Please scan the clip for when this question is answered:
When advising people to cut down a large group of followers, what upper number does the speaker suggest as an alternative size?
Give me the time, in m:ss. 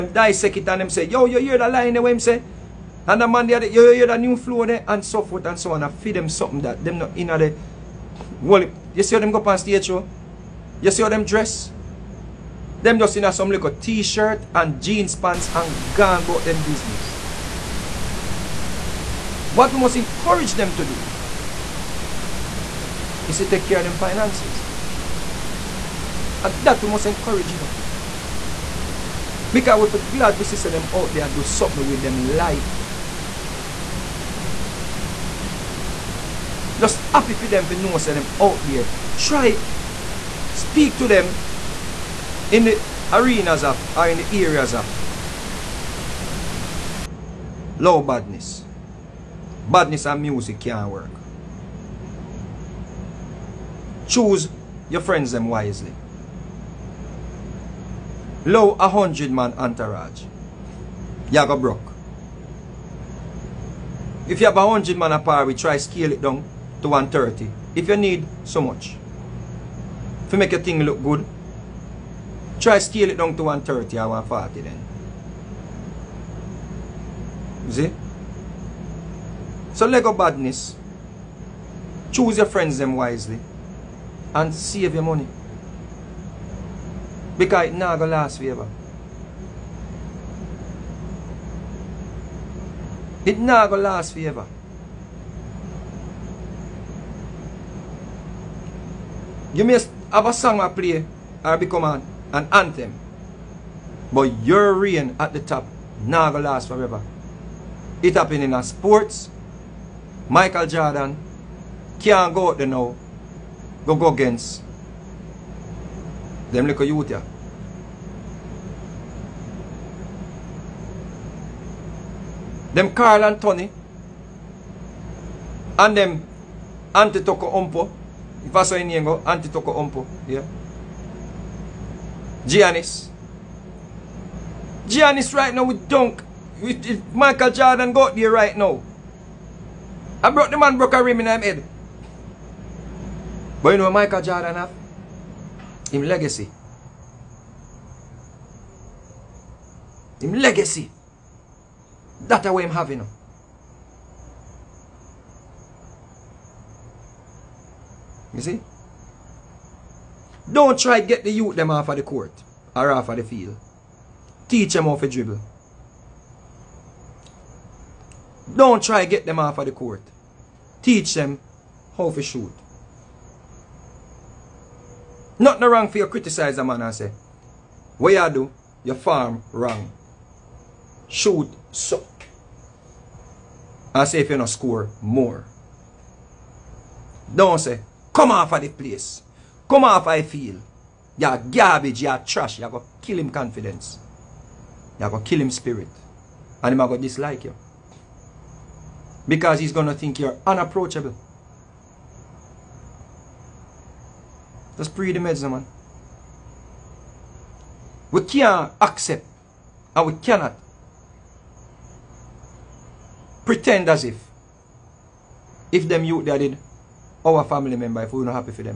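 1:14.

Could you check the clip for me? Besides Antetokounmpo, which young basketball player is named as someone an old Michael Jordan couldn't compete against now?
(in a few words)
Karl-Anthony.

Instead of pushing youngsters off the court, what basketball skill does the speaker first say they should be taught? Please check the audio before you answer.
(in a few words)
dribble.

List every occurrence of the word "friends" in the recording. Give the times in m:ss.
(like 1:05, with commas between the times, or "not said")
0:54, 1:22.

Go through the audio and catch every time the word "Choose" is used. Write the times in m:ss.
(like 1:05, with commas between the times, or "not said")
0:54, 1:22.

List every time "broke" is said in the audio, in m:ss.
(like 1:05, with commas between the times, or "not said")
1:01, 2:20.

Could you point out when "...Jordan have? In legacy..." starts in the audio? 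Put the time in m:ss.
2:24.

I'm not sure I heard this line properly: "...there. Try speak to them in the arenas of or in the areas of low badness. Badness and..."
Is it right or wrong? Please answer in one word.
right.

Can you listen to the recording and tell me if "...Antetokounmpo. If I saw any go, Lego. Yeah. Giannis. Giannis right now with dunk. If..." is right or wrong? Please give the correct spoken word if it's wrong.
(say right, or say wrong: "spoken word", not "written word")
wrong: "Antetokounmpo", not "Lego".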